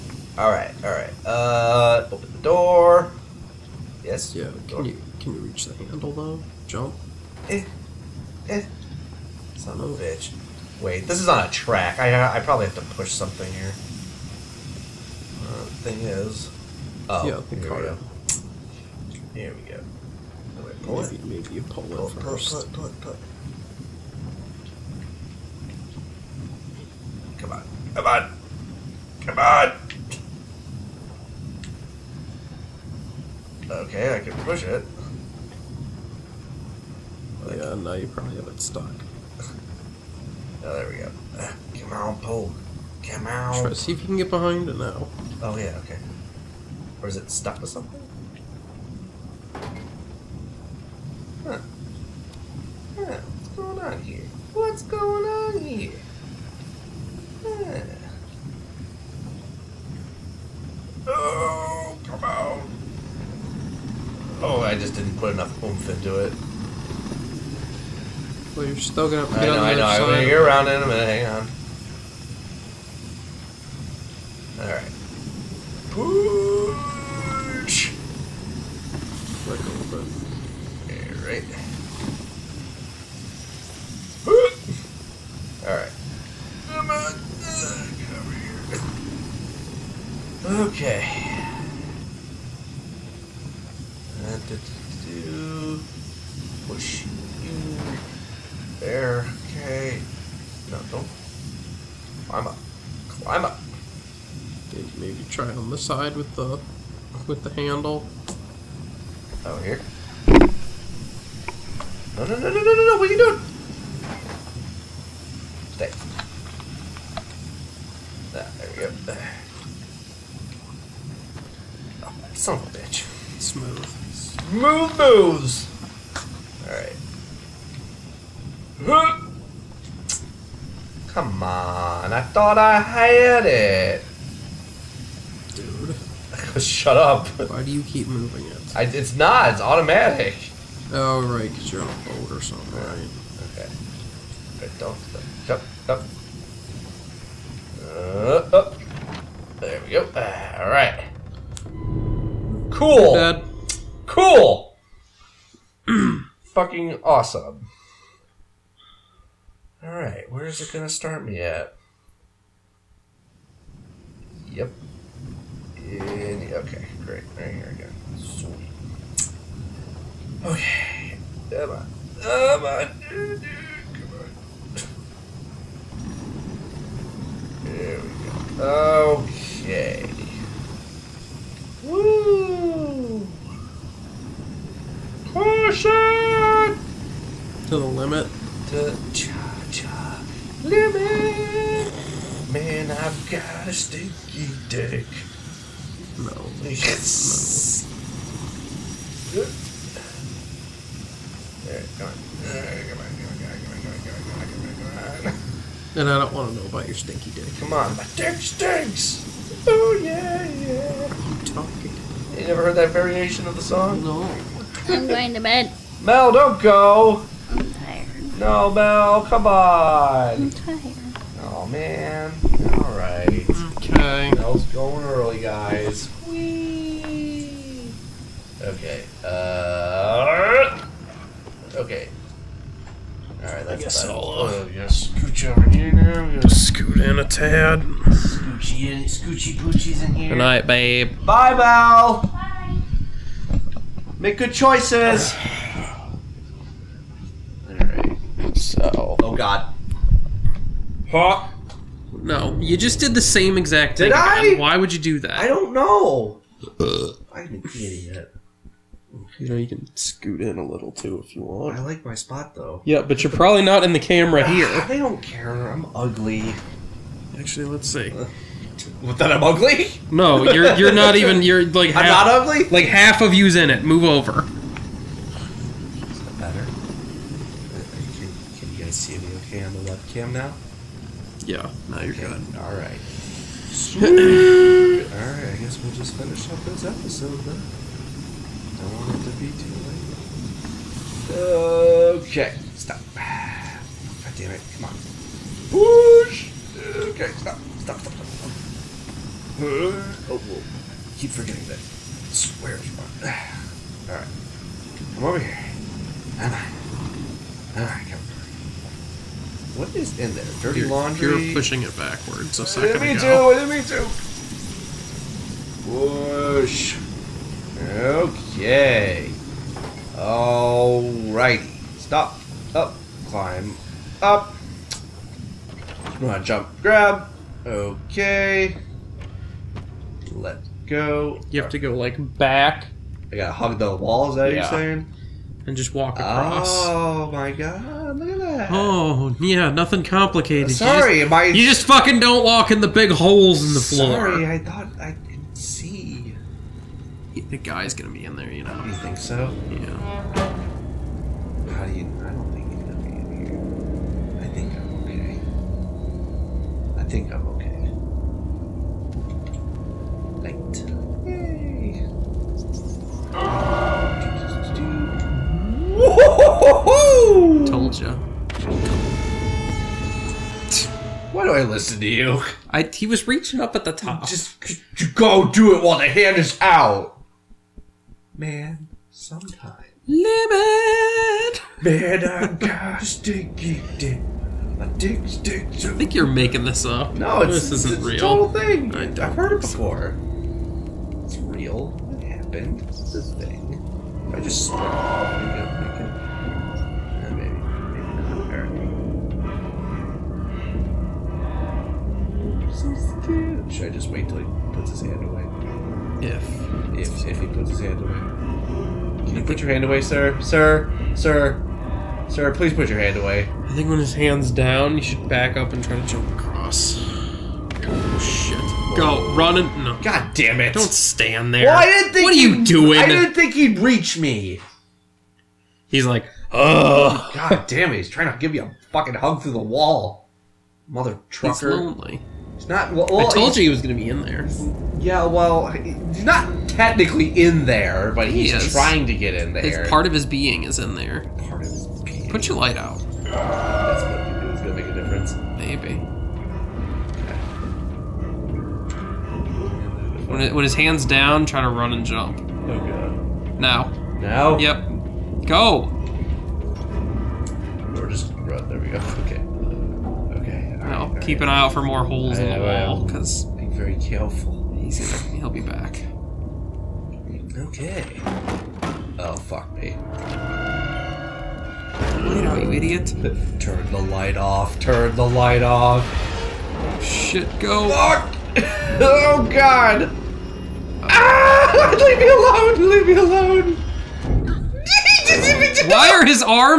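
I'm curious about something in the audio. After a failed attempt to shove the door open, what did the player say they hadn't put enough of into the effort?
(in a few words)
oomph.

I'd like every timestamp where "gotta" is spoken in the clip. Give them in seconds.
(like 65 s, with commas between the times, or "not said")
236 s, 333 s.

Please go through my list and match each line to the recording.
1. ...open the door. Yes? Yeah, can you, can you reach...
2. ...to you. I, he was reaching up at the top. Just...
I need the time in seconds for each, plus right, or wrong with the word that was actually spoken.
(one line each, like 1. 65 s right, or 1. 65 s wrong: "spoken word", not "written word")
1. 2 s right
2. 372 s right.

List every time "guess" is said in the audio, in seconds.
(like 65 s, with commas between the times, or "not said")
233 s, 285 s.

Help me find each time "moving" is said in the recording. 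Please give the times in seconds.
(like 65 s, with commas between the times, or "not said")
138 s.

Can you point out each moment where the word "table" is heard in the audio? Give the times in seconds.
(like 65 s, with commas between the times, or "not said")
not said.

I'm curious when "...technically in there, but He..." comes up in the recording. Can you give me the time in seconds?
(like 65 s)
436 s.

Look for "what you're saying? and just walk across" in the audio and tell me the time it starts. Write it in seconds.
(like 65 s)
334 s.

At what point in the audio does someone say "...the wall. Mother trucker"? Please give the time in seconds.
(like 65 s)
429 s.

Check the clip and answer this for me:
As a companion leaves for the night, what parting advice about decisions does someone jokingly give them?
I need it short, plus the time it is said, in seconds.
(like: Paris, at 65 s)
Make good choices, at 244 s.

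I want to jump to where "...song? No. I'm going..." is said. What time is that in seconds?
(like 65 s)
213 s.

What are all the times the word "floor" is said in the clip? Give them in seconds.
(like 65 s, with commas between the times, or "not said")
343 s.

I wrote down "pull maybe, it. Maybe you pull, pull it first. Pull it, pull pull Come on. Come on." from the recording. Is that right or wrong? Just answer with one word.
right.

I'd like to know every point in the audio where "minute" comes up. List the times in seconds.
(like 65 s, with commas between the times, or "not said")
70 s.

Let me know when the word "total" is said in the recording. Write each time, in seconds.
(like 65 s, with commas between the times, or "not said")
388 s.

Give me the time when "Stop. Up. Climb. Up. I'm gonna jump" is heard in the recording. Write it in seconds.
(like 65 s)
321 s.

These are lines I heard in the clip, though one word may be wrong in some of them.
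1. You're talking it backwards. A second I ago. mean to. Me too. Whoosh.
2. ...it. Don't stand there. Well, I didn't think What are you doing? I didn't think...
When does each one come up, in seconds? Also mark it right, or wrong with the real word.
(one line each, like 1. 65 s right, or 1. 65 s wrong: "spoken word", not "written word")
1. 311 s wrong: "pushing", not "talking"
2. 420 s right.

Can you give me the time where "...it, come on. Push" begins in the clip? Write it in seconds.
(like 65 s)
294 s.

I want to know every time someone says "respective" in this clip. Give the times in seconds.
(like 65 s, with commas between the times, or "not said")
not said.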